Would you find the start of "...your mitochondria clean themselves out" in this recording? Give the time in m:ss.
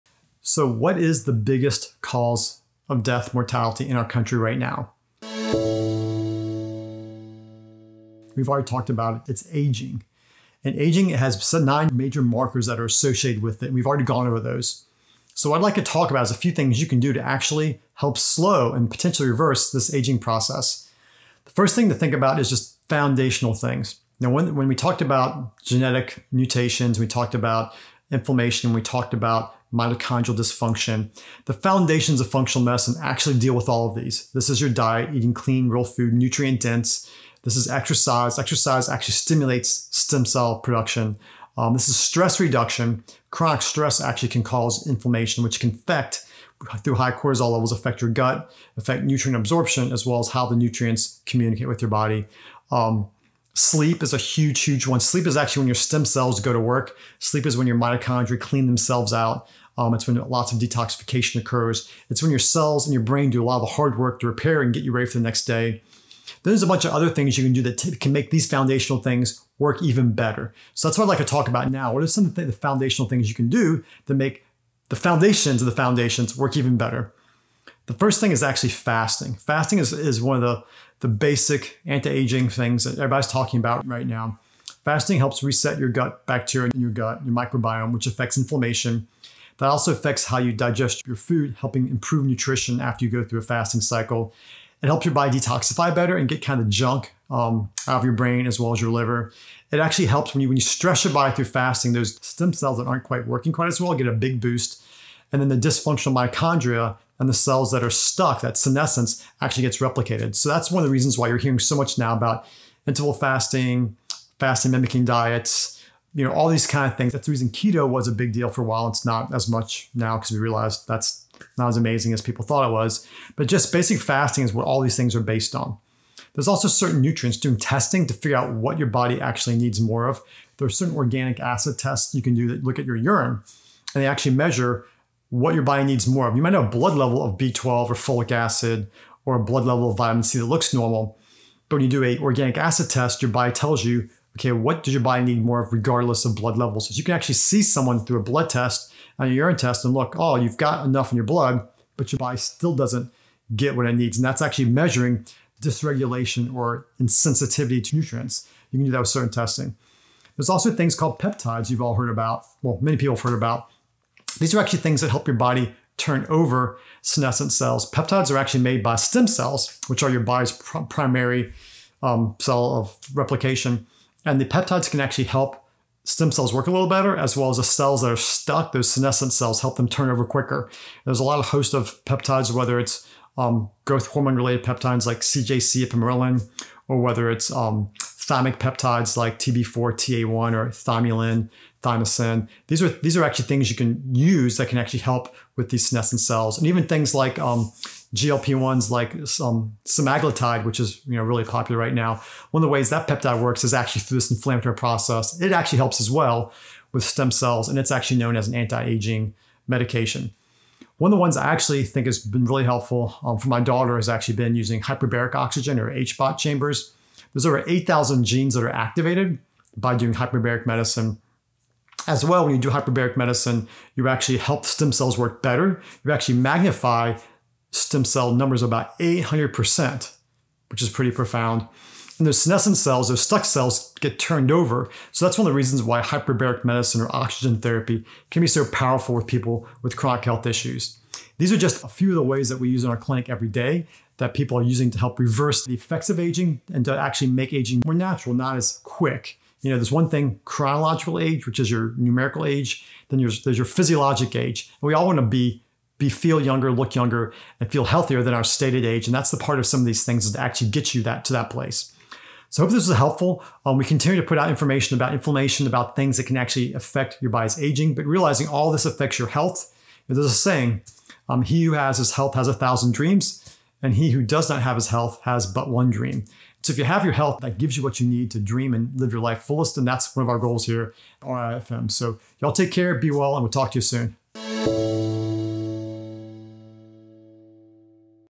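0:57.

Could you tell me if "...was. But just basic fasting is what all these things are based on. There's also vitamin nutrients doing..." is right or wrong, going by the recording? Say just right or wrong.
wrong.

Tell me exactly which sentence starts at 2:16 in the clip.
You might have a blood level of B12 or folic acid or a blood level of vitamin C that looks normal.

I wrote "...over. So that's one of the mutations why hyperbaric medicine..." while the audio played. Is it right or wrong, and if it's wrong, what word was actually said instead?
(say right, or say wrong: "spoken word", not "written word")
wrong: "reasons", not "mutations".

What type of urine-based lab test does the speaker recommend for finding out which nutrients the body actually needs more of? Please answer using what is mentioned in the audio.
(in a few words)
organic acid test.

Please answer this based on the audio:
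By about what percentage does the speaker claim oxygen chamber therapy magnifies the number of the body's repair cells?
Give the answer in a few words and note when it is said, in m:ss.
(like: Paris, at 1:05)
800%, at 3:48.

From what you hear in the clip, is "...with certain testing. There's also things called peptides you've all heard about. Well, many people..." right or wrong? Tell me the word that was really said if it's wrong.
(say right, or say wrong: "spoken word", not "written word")
right.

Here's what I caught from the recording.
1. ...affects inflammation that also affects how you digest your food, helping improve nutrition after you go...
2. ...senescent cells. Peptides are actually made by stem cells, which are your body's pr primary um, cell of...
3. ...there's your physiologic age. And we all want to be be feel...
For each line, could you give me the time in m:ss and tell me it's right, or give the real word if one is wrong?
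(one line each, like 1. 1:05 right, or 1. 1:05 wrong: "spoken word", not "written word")
1. 1:28 right
2. 2:47 right
3. 4:13 right.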